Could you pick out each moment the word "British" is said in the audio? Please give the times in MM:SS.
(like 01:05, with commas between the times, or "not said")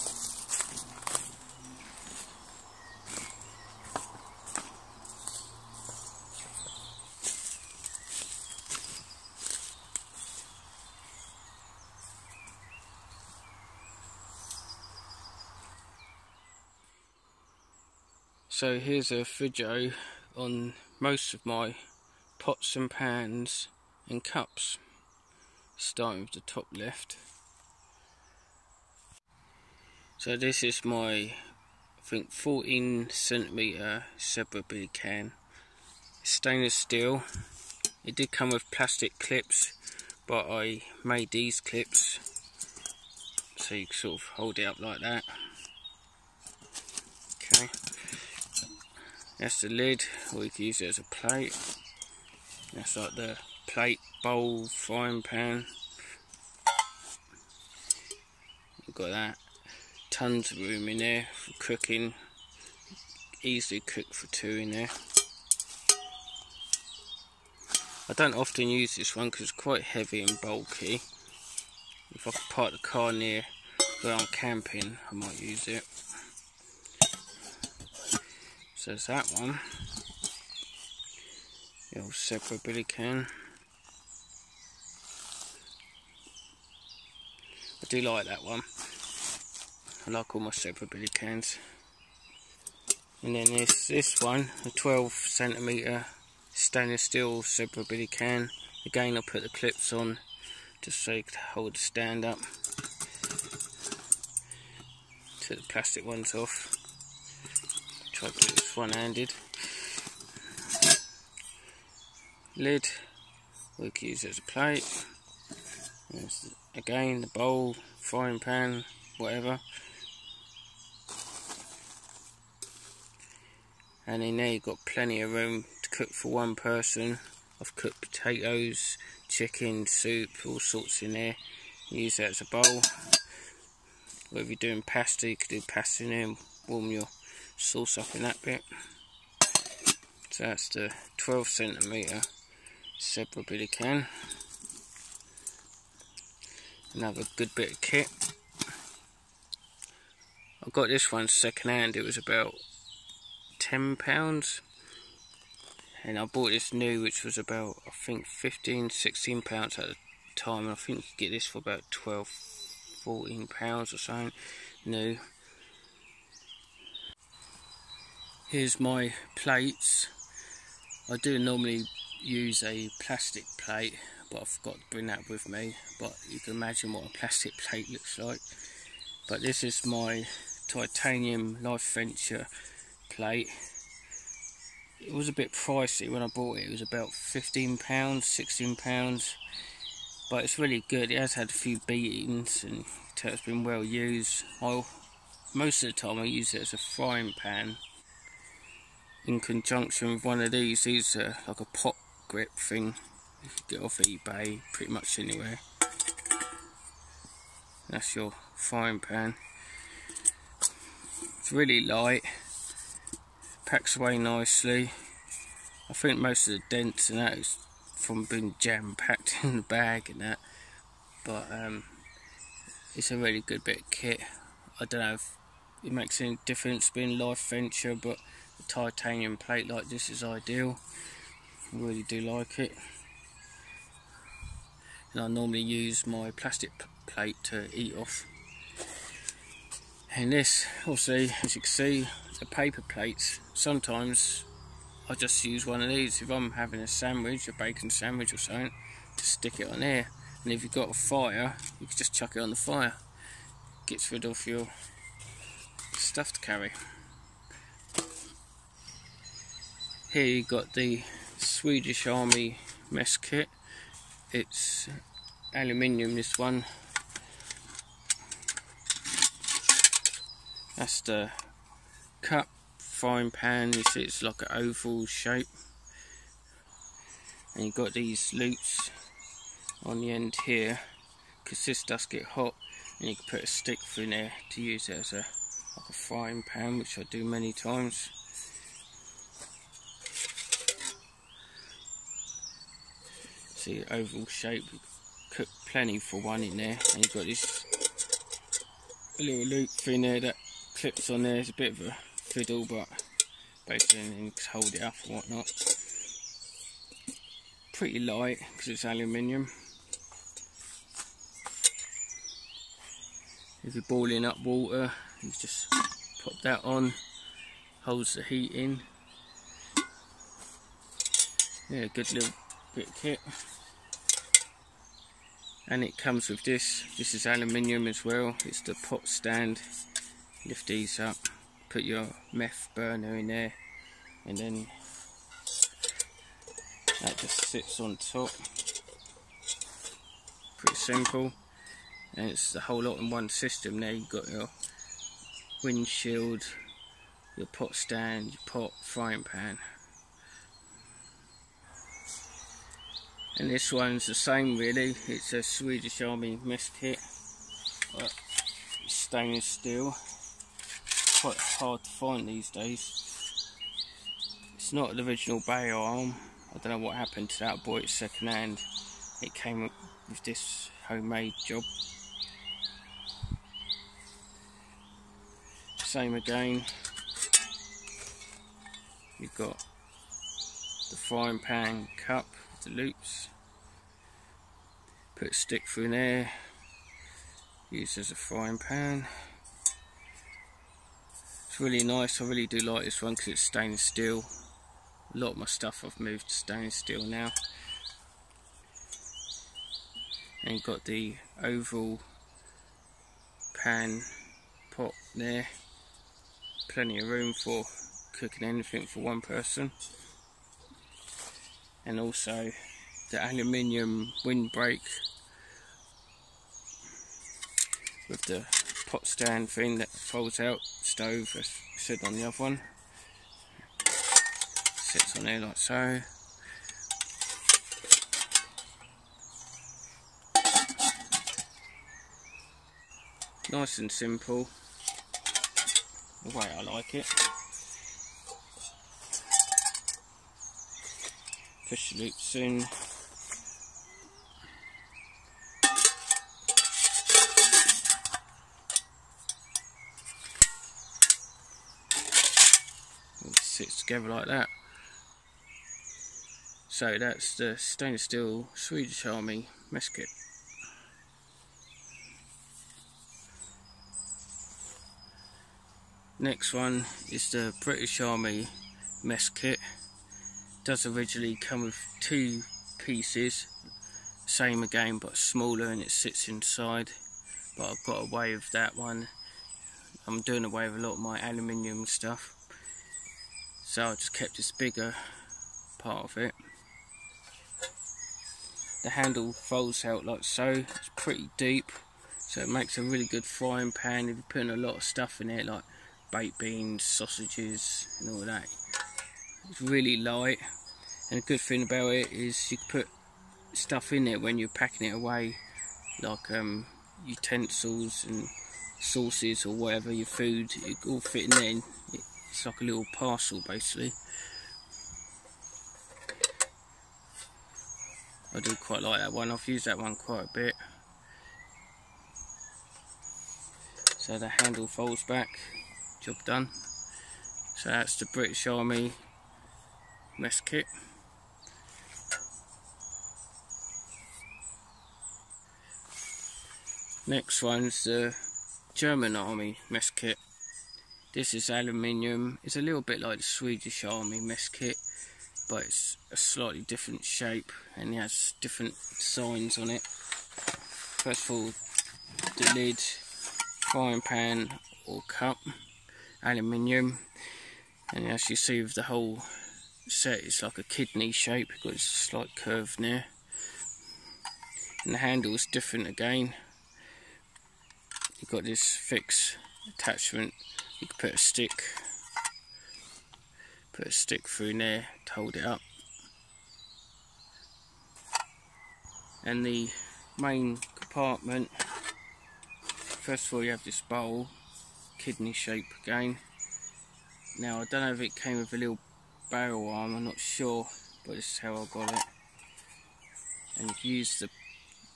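07:47, 08:48.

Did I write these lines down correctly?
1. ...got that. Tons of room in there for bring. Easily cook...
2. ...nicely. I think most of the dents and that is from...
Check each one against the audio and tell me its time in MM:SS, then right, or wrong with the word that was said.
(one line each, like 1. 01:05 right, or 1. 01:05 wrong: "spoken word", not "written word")
1. 00:58 wrong: "cooking", not "bring"
2. 03:34 right.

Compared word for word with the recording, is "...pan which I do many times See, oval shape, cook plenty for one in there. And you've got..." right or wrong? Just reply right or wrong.
right.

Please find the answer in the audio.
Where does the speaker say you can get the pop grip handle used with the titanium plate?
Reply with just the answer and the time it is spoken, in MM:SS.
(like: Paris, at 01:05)
eBay, at 03:23.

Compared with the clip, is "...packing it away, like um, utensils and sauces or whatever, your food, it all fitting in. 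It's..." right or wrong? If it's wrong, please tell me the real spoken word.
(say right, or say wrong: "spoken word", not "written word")
right.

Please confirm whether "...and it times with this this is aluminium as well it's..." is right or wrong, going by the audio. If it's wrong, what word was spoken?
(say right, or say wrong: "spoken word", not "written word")
wrong: "comes", not "times".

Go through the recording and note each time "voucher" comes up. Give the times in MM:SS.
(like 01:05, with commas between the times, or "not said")
not said.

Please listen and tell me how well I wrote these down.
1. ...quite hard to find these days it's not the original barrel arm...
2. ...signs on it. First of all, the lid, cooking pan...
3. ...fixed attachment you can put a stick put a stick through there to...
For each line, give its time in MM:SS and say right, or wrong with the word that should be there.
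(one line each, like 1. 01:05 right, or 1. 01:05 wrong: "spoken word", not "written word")
1. 06:01 right
2. 09:08 wrong: "frying", not "cooking"
3. 09:28 right.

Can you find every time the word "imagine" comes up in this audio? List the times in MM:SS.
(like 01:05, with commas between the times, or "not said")
02:56.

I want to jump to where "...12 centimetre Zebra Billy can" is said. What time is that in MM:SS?
02:21.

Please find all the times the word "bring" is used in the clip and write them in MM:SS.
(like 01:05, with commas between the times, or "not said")
02:54.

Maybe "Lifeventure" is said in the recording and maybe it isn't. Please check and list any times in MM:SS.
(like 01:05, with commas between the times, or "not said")
03:01, 03:47.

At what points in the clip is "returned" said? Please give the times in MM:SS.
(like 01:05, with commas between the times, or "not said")
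not said.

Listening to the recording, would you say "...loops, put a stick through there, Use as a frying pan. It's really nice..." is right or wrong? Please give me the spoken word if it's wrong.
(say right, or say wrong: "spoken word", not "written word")
right.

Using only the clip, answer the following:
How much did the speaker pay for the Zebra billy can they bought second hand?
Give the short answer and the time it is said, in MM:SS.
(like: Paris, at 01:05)
£10, at 02:32.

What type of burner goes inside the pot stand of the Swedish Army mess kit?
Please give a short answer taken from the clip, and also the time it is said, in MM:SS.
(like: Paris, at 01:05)
Meth burner, at 05:32.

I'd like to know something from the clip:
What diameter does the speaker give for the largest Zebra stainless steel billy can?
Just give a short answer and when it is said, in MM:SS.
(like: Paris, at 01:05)
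14 centimetres, at 00:32.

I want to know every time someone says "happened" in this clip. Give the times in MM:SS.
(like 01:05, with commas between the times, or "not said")
06:06.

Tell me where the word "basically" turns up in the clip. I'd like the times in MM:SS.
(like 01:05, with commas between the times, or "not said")
05:03, 08:33.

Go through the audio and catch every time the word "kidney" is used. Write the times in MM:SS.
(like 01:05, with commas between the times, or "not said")
09:20, 09:44.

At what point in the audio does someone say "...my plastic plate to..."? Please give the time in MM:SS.
03:56.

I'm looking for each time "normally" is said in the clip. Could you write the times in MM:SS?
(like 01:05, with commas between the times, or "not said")
02:51, 03:55.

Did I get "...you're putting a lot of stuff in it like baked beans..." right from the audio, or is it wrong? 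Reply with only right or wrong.
right.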